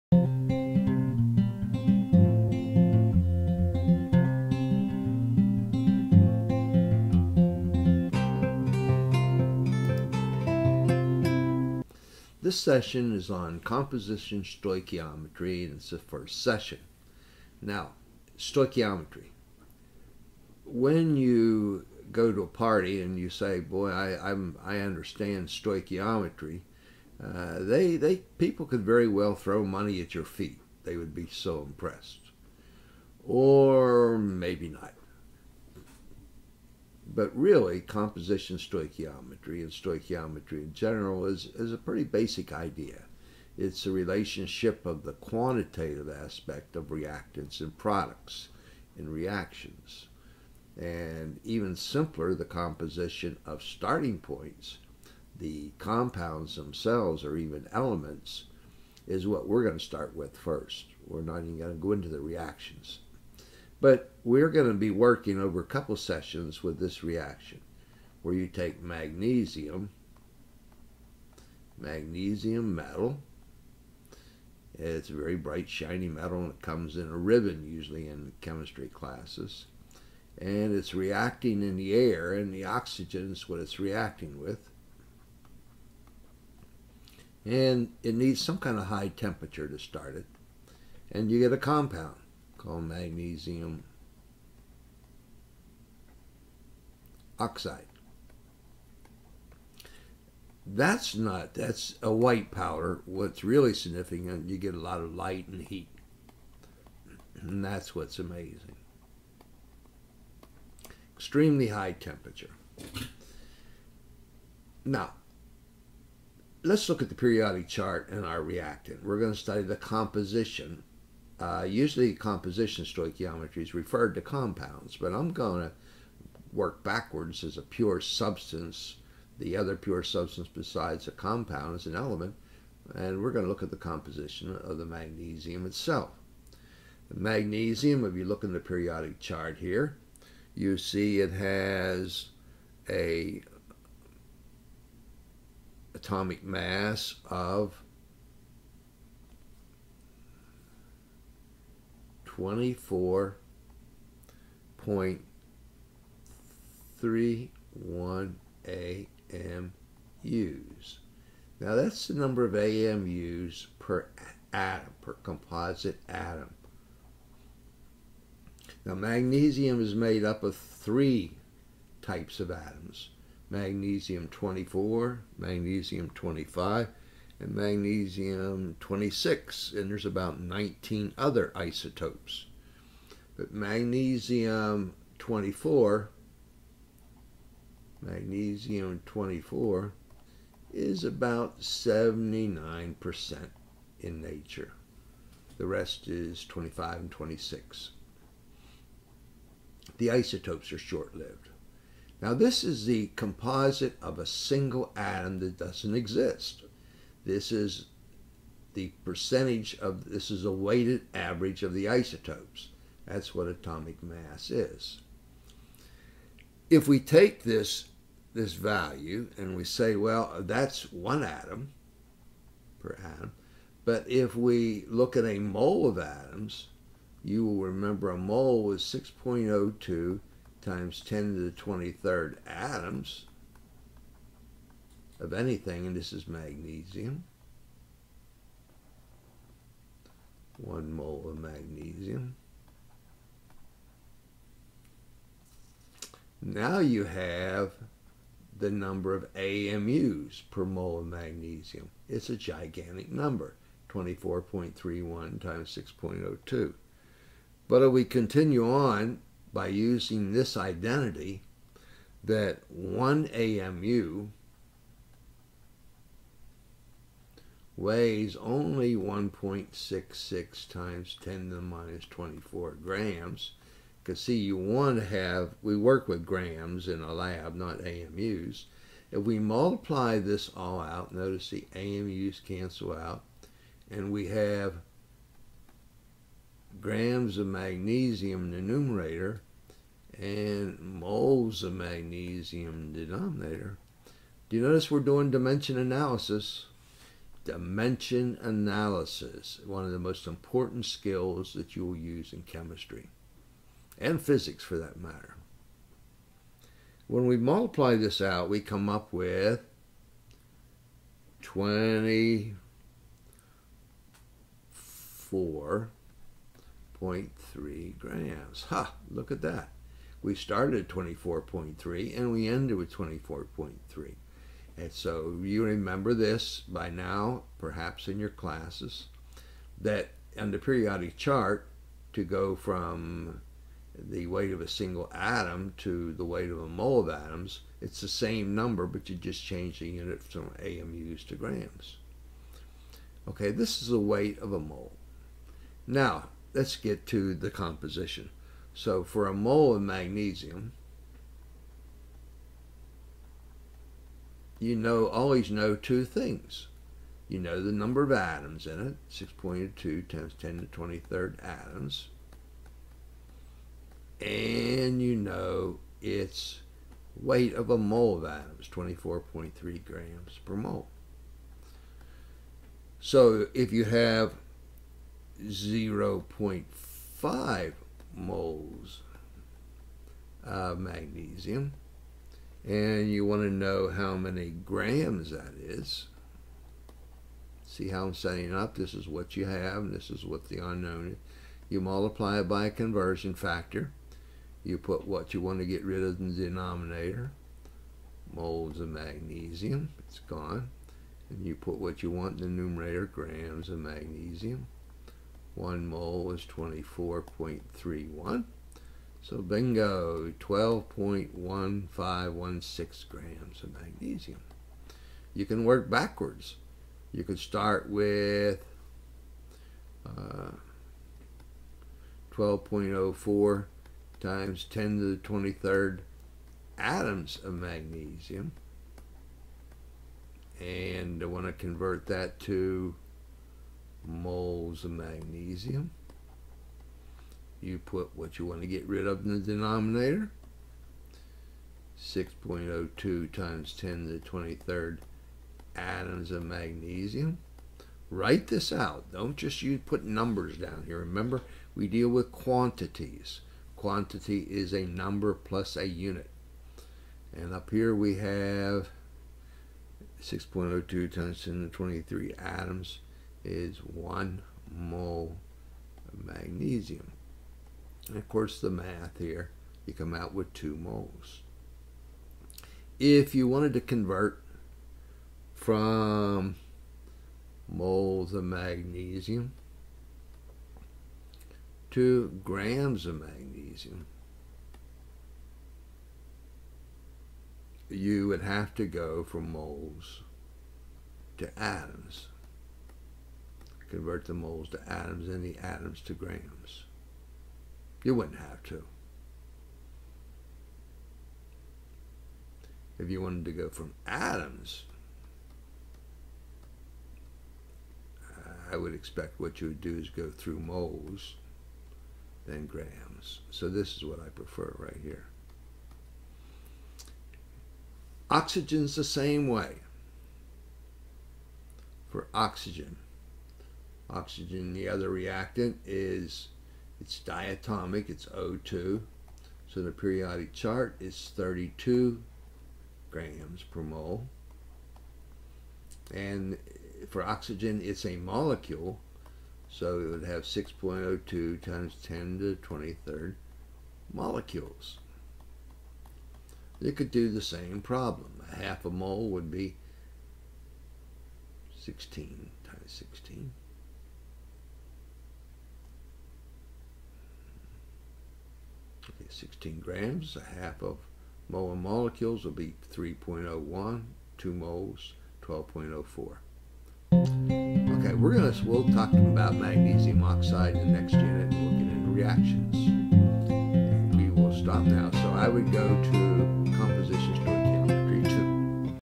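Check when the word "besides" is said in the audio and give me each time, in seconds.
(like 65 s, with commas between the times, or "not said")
130 s.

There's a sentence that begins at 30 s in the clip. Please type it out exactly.
They would be so impressed, or maybe not but really, composition stoichiometry and stoichiometry in general is, is a pretty basic idea.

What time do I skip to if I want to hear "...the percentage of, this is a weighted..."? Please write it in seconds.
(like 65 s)
208 s.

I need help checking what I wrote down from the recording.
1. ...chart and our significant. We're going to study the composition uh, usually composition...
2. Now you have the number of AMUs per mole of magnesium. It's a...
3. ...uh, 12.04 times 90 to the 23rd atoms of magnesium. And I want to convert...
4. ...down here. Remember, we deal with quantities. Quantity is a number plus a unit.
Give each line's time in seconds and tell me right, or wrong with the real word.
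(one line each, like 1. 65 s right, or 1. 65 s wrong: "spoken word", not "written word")
1. 117 s wrong: "reactant", not "significant"
2. 246 s right
3. 420 s wrong: "10", not "90"
4. 450 s right.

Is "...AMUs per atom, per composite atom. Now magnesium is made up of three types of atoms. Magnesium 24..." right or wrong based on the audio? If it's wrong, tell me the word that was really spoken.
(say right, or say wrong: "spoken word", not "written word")
right.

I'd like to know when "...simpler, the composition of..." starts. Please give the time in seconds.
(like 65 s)
51 s.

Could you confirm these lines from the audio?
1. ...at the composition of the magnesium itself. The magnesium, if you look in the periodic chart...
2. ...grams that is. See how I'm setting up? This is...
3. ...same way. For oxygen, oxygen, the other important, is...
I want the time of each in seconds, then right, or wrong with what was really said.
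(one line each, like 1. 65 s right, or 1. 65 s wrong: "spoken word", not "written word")
1. 133 s right
2. 384 s right
3. 519 s wrong: "reactant", not "important".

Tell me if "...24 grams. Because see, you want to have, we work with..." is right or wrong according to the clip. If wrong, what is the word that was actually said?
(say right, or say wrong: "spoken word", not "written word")
right.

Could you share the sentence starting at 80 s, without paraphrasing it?
And it's reacting in the air, and the oxygen is what it's reacting with.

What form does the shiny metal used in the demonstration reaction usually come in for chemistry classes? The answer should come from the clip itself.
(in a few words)
a ribbon.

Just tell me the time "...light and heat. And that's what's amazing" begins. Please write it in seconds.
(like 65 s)
105 s.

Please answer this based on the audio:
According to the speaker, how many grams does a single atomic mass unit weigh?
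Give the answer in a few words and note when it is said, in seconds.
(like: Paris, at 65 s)
1.66 x 10^-24 grams, at 268 s.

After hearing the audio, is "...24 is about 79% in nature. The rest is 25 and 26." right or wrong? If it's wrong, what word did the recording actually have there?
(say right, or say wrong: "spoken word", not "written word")
right.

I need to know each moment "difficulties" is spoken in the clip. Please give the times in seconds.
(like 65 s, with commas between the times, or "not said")
not said.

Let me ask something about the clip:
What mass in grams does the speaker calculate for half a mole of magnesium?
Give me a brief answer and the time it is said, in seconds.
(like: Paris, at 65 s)
12.1516 grams, at 410 s.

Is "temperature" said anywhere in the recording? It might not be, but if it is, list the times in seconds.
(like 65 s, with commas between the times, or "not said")
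89 s, 111 s.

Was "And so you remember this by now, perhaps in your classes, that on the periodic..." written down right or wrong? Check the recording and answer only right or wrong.
right.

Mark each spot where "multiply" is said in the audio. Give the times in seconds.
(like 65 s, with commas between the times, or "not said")
279 s, 307 s, 391 s.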